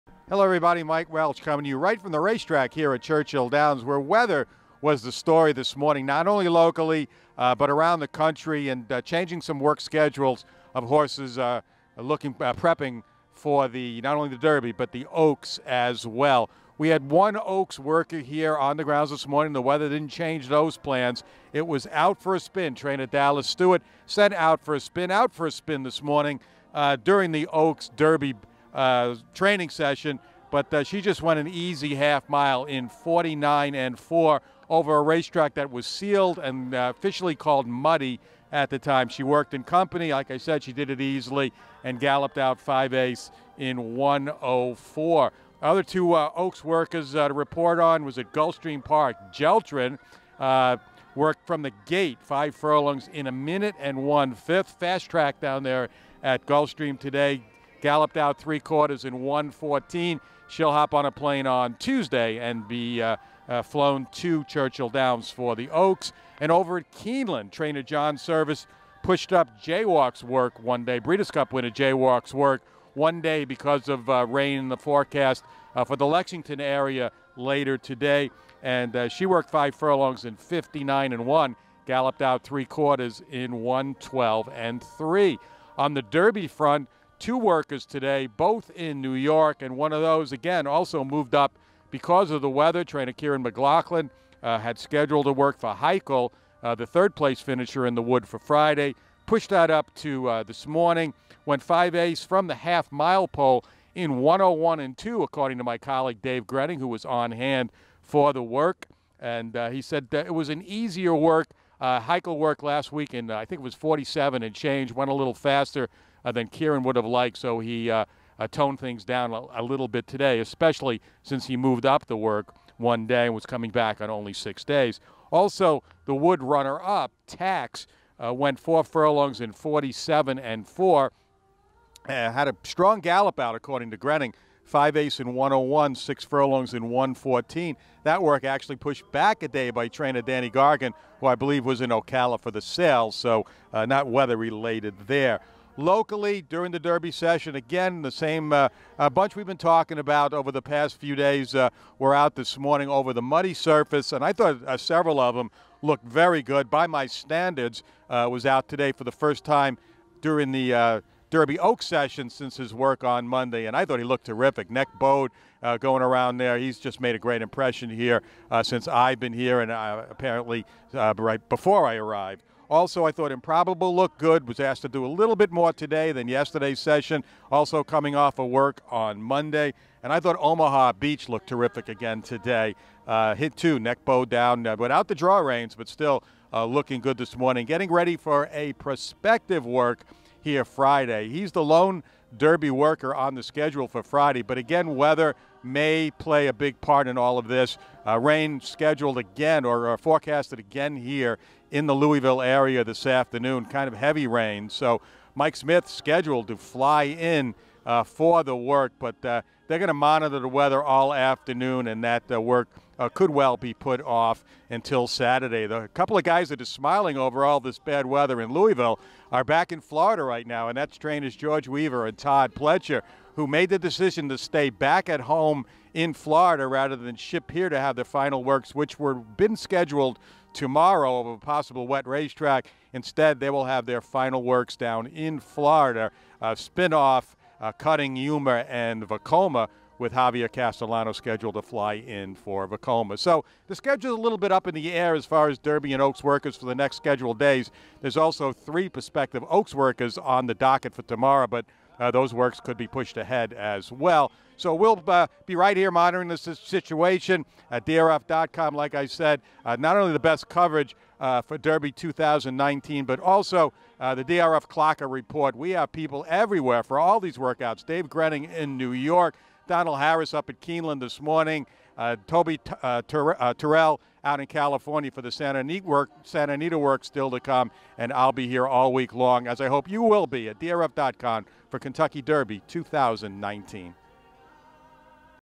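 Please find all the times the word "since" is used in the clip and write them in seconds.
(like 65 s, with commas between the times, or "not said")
121 s, 162 s, 168 s.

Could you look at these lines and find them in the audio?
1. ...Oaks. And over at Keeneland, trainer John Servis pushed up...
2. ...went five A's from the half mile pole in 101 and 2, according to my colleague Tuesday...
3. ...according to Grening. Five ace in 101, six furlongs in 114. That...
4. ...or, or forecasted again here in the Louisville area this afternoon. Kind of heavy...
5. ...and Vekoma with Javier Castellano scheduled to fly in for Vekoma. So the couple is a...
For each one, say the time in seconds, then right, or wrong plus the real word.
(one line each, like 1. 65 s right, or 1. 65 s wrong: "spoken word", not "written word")
1. 65 s right
2. 101 s wrong: "Dave", not "Tuesday"
3. 133 s right
4. 199 s right
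5. 238 s wrong: "schedule", not "couple".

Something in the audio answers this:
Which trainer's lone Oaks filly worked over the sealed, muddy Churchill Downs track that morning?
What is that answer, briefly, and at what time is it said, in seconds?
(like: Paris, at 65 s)
Dallas Stewart, at 23 s.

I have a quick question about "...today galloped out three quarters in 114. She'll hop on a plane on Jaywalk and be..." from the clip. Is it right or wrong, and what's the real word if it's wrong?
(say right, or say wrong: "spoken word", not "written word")
wrong: "Tuesday", not "Jaywalk".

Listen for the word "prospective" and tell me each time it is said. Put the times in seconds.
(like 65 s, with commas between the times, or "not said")
188 s, 248 s.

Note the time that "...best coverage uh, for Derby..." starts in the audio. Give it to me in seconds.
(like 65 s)
260 s.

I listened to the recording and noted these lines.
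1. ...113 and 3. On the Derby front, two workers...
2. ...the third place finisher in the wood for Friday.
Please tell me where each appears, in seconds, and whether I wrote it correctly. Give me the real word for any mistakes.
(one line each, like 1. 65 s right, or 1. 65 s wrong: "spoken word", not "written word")
1. 83 s wrong: "112", not "113"
2. 96 s right.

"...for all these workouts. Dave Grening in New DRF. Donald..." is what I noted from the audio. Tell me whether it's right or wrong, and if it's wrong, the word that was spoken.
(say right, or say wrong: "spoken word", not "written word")
wrong: "York", not "DRF".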